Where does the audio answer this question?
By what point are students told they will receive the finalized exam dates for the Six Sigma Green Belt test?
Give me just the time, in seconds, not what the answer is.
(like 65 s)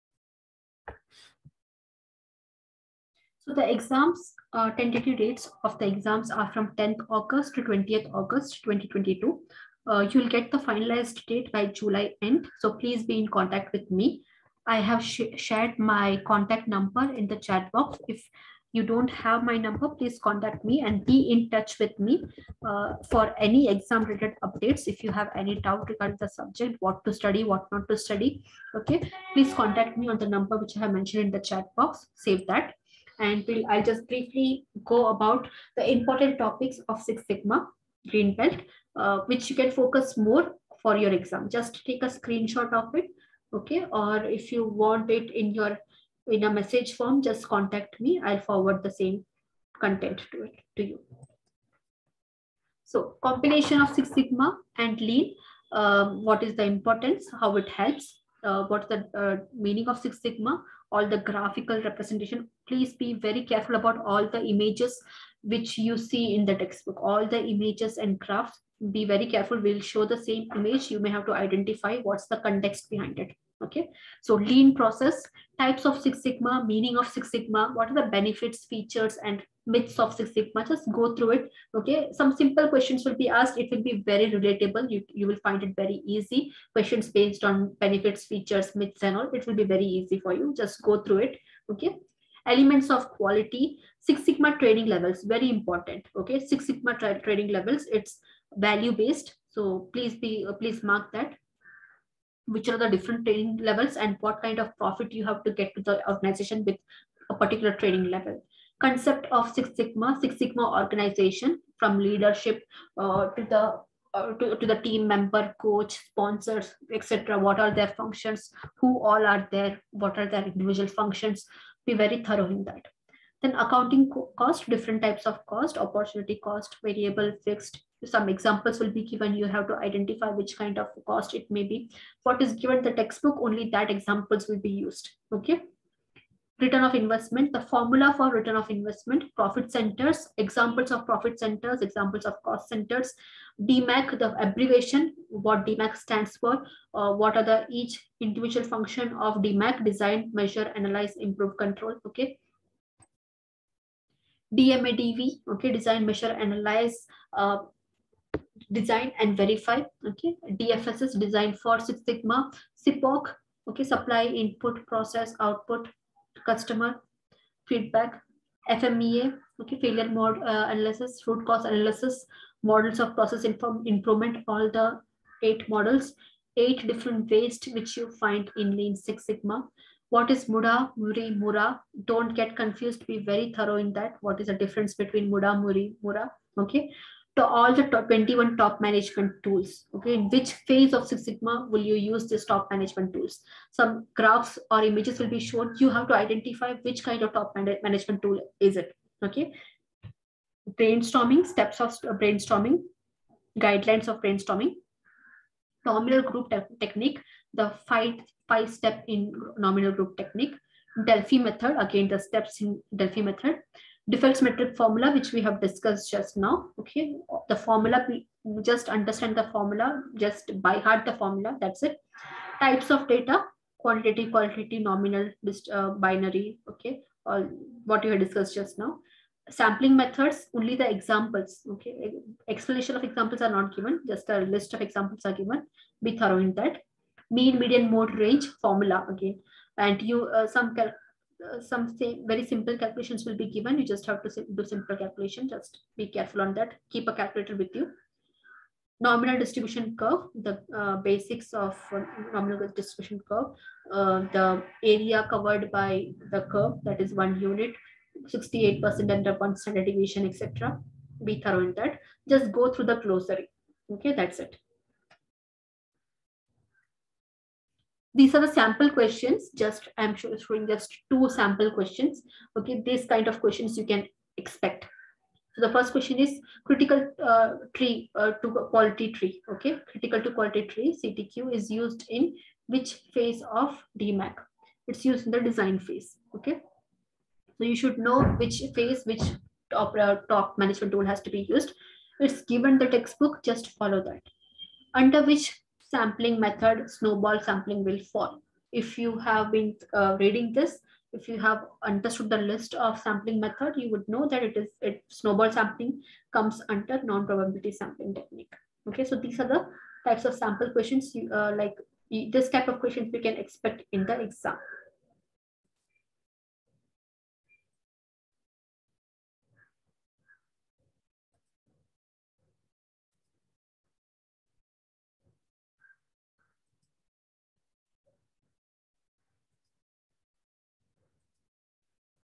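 11 s.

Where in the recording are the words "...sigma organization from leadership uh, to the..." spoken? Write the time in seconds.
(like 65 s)
110 s.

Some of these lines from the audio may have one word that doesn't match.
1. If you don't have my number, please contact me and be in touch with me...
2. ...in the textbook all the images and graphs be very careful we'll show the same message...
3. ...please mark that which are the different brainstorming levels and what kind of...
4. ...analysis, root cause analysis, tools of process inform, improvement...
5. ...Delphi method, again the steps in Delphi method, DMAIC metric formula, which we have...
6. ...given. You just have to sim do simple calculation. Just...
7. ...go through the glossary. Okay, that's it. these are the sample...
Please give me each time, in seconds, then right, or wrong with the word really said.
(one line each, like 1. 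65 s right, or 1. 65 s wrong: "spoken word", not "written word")
1. 18 s right
2. 66 s wrong: "image", not "message"
3. 100 s wrong: "training", not "brainstorming"
4. 170 s wrong: "models", not "tools"
5. 211 s wrong: "Defects", not "DMAIC"
6. 243 s right
7. 262 s right.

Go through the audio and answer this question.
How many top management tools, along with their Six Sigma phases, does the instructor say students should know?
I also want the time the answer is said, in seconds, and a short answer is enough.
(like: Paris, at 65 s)
21, at 188 s.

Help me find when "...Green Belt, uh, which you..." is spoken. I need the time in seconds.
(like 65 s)
38 s.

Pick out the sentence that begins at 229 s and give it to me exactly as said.
Sampling methods, only the examples, okay.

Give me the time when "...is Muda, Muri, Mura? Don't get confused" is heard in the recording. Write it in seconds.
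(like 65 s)
180 s.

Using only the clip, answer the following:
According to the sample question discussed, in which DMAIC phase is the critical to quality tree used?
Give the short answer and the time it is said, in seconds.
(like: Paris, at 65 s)
Design phase, at 285 s.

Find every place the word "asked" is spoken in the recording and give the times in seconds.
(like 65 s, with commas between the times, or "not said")
83 s.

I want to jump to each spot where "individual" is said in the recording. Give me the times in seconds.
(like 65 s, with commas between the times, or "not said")
120 s, 148 s.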